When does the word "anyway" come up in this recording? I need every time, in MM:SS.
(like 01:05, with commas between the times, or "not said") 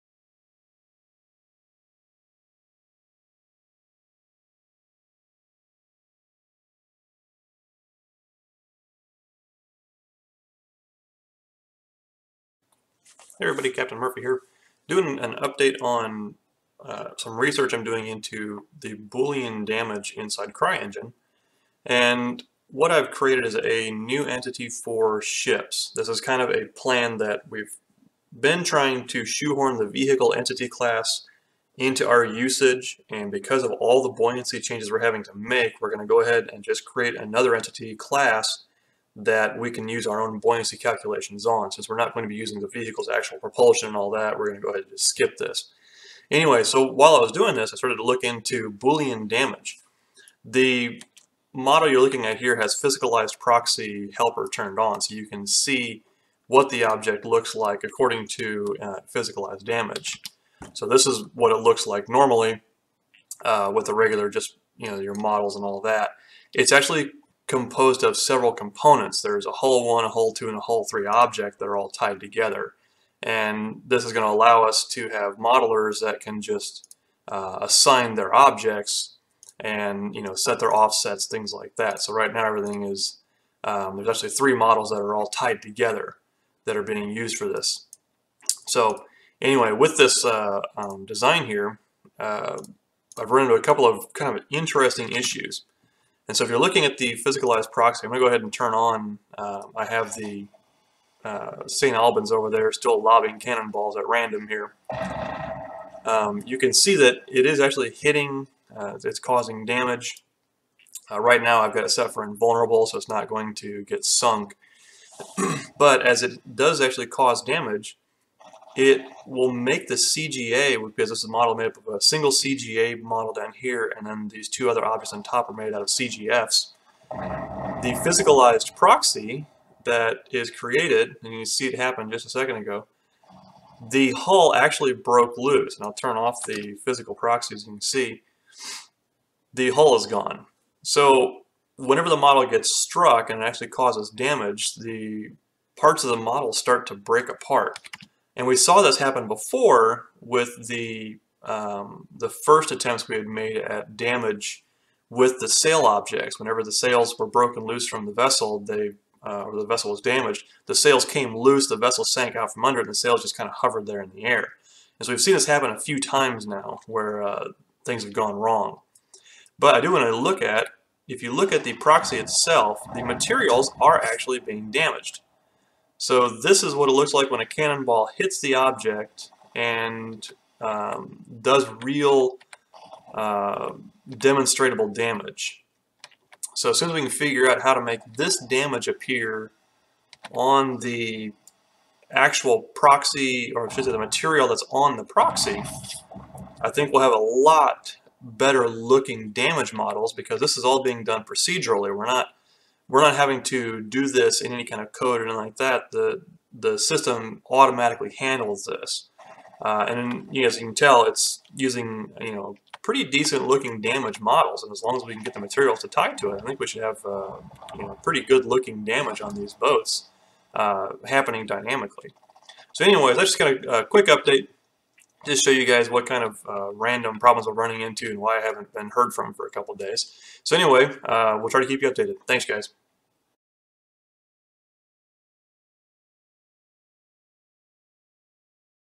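00:46, 01:29, 03:42, 03:50.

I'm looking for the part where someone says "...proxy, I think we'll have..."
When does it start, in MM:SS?
03:15.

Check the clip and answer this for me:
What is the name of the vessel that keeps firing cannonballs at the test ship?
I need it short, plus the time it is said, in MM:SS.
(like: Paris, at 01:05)
St. Albans, at 01:41.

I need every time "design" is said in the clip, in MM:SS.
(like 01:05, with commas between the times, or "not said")
01:31.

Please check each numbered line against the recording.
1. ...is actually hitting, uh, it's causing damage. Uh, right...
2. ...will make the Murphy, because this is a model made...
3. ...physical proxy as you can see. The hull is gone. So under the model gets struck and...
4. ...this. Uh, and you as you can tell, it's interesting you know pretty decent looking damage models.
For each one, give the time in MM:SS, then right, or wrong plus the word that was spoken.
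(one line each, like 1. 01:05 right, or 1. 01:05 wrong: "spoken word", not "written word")
1. 01:47 right
2. 01:59 wrong: "CGA", not "Murphy"
3. 02:16 wrong: "whenever", not "under"
4. 03:28 wrong: "using", not "interesting".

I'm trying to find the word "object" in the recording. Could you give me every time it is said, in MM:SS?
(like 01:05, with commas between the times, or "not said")
00:56, 01:11, 01:18, 02:04, 02:35, 02:58.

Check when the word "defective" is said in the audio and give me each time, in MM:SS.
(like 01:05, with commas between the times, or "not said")
not said.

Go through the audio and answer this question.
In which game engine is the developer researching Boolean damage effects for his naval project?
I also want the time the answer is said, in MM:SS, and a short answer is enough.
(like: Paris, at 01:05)
CryEngine, at 00:20.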